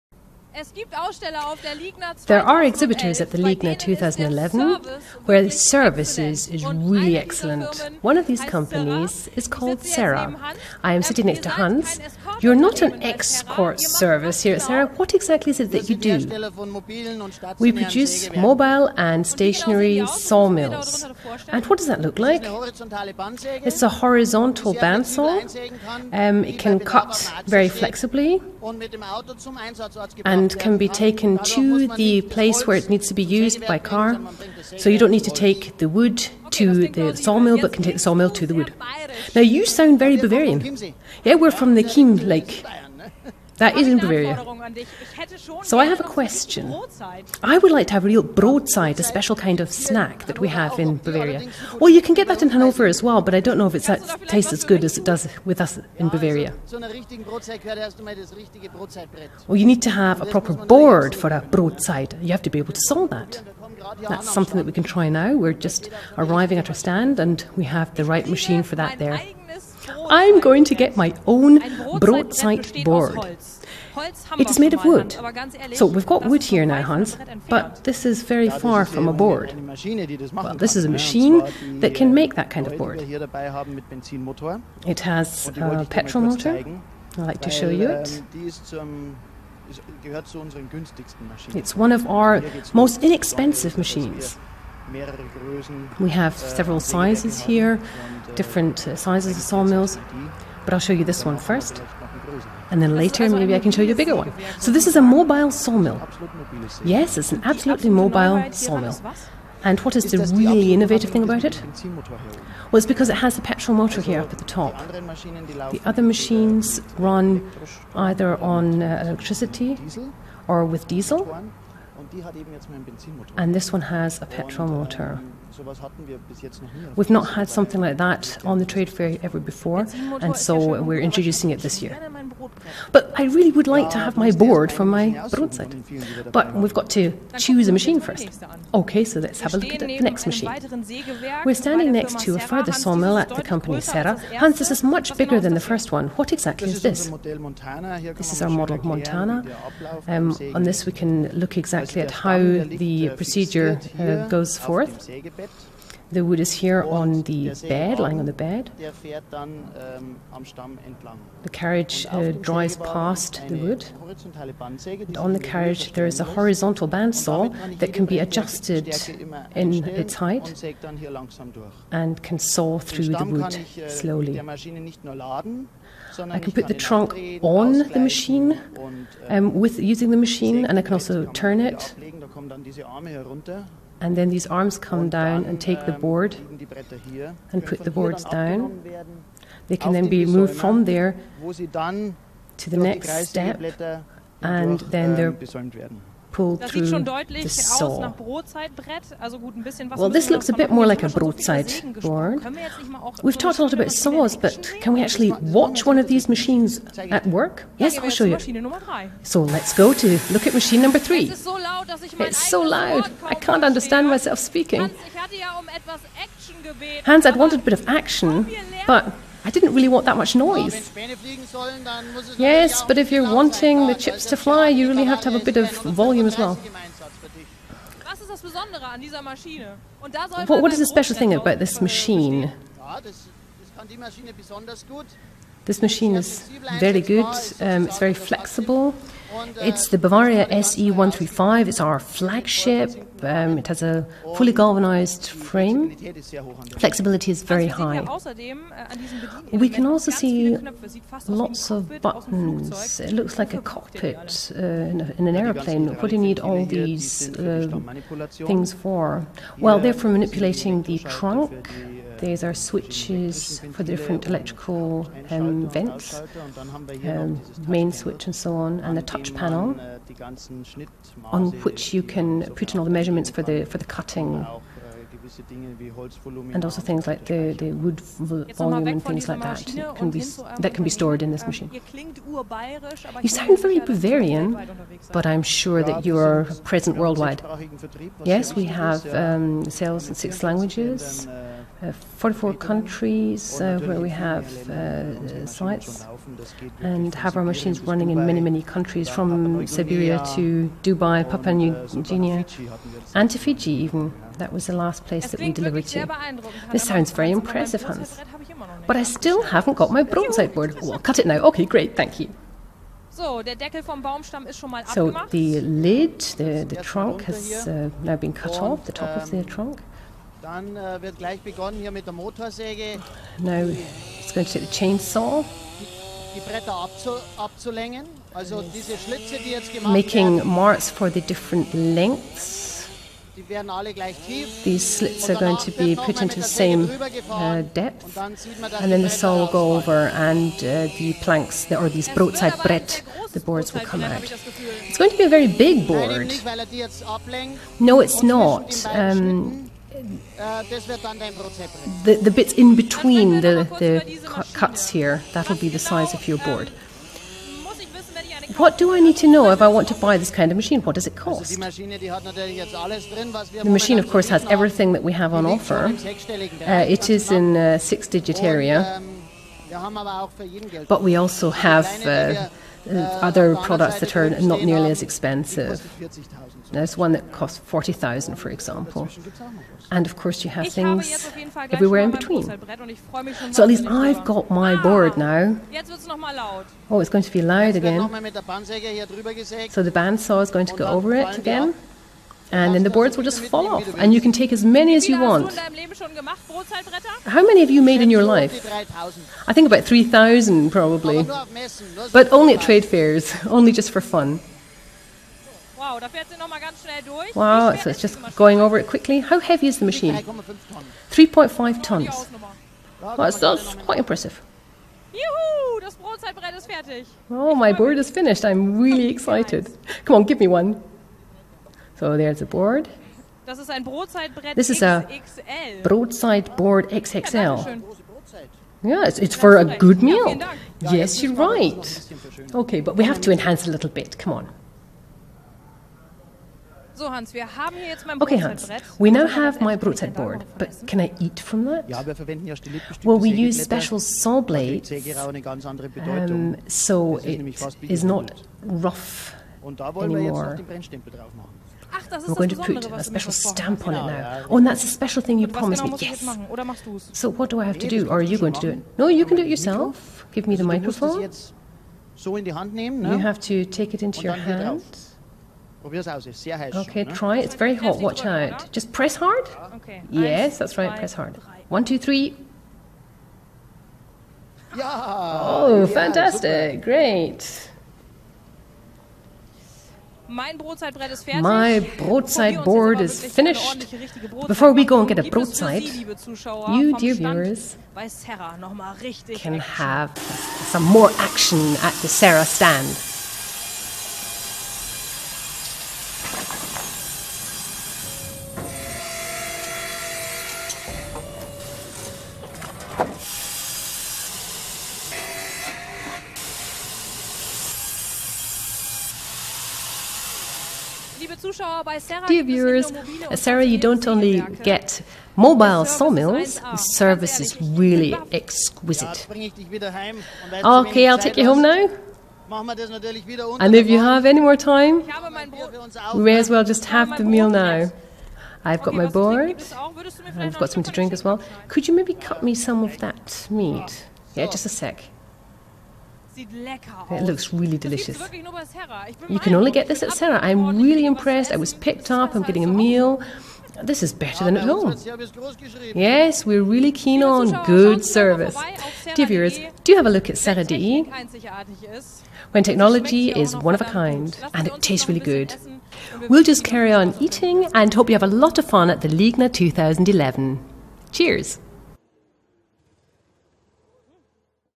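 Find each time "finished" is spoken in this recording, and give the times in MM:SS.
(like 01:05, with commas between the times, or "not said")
06:58, 08:03.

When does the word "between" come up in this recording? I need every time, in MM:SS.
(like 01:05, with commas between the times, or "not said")
05:52, 06:22.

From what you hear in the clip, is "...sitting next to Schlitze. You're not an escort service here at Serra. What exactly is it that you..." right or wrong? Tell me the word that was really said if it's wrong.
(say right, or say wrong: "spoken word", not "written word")
wrong: "Hans", not "Schlitze".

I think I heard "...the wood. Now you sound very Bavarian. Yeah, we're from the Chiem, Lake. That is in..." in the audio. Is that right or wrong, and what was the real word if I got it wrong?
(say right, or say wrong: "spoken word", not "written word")
right.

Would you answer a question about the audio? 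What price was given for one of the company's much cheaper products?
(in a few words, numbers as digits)
40,000.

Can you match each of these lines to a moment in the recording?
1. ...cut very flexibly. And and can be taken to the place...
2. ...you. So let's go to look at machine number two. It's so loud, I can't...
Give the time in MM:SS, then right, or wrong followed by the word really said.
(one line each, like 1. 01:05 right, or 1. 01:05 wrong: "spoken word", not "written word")
1. 00:26 right
2. 03:28 wrong: "three", not "two".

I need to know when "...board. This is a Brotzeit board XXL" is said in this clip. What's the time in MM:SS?
07:02.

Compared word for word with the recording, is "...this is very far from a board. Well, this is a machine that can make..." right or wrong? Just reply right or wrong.
right.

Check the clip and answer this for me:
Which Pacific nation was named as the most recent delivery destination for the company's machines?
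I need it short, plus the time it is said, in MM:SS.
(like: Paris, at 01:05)
Fiji, at 05:03.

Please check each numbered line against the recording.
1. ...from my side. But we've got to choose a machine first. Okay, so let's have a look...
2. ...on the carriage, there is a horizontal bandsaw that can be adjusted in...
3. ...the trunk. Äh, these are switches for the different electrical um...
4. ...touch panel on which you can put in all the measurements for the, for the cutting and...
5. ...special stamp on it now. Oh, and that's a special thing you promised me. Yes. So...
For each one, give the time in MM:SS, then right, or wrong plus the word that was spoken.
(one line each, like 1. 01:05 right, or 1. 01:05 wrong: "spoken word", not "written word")
1. 02:14 right
2. 02:45 right
3. 04:20 right
4. 04:29 right
5. 07:33 right.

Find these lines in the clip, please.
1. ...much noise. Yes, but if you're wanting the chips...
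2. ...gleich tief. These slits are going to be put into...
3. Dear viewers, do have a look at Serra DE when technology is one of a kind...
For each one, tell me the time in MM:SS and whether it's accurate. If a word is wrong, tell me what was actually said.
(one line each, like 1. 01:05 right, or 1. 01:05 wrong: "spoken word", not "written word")
1. 03:40 right
2. 05:33 right
3. 09:09 right.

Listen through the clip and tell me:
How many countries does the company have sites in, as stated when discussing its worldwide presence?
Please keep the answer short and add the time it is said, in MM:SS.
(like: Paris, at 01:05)
44, at 04:52.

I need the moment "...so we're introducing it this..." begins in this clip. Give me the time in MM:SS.
02:10.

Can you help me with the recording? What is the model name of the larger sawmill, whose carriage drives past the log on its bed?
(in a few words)
Montana.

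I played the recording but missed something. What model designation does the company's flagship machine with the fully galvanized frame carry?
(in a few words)
Bavaria SE135.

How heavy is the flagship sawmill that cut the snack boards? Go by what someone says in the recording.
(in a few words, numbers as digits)
3.5 tons.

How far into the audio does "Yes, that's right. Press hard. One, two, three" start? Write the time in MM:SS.
07:50.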